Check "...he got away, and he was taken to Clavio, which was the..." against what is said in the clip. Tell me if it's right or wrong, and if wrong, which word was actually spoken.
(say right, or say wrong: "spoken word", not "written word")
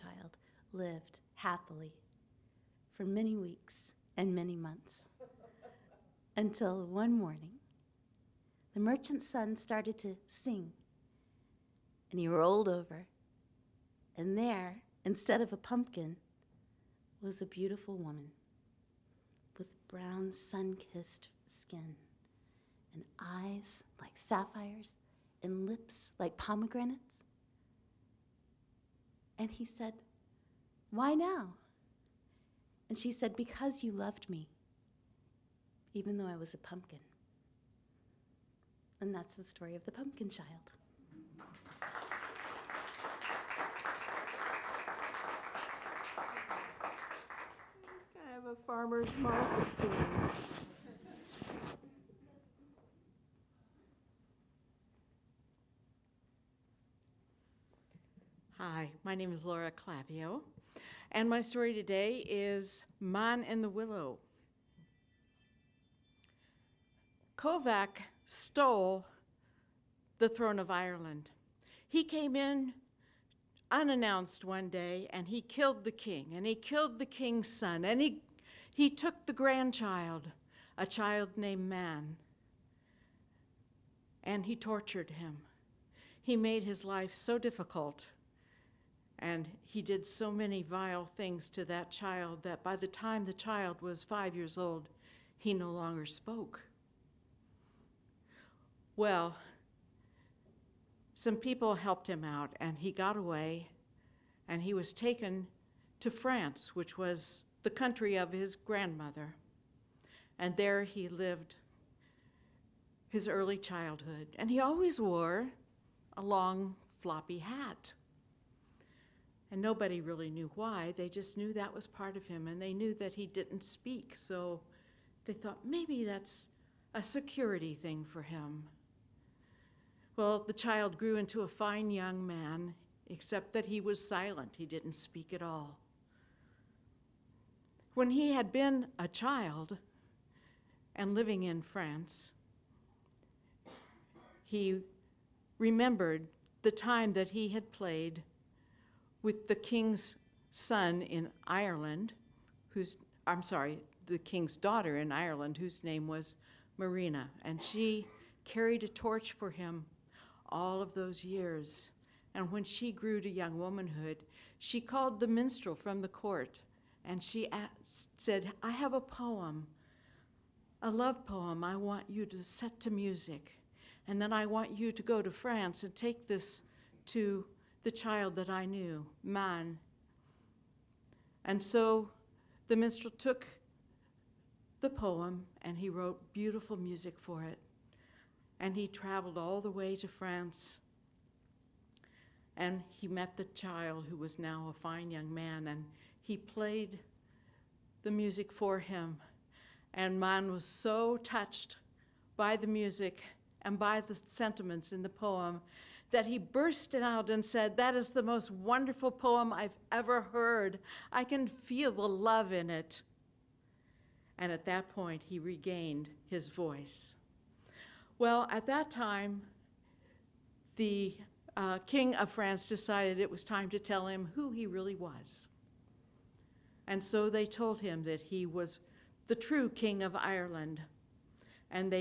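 wrong: "France", not "Clavio".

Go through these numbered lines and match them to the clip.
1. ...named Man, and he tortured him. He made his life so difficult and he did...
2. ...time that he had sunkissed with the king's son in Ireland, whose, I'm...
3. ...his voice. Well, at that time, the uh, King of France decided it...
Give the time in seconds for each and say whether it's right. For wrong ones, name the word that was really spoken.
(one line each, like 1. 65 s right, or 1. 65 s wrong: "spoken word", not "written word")
1. 81 s right
2. 146 s wrong: "played", not "sunkissed"
3. 216 s right.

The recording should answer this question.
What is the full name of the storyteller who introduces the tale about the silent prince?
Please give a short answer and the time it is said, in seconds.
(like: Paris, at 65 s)
Laura Clavio, at 59 s.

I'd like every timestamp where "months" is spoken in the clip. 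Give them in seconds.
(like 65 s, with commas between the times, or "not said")
4 s.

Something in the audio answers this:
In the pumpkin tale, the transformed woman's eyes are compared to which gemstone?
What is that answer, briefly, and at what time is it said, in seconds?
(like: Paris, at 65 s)
Sapphires, at 24 s.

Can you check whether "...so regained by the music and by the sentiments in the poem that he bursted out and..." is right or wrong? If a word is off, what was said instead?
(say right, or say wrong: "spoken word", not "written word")
wrong: "touched", not "regained".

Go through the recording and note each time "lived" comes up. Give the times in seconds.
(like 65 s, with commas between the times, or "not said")
0 s, 111 s.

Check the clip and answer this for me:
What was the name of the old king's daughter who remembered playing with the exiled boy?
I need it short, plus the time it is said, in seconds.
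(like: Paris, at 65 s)
Marina, at 156 s.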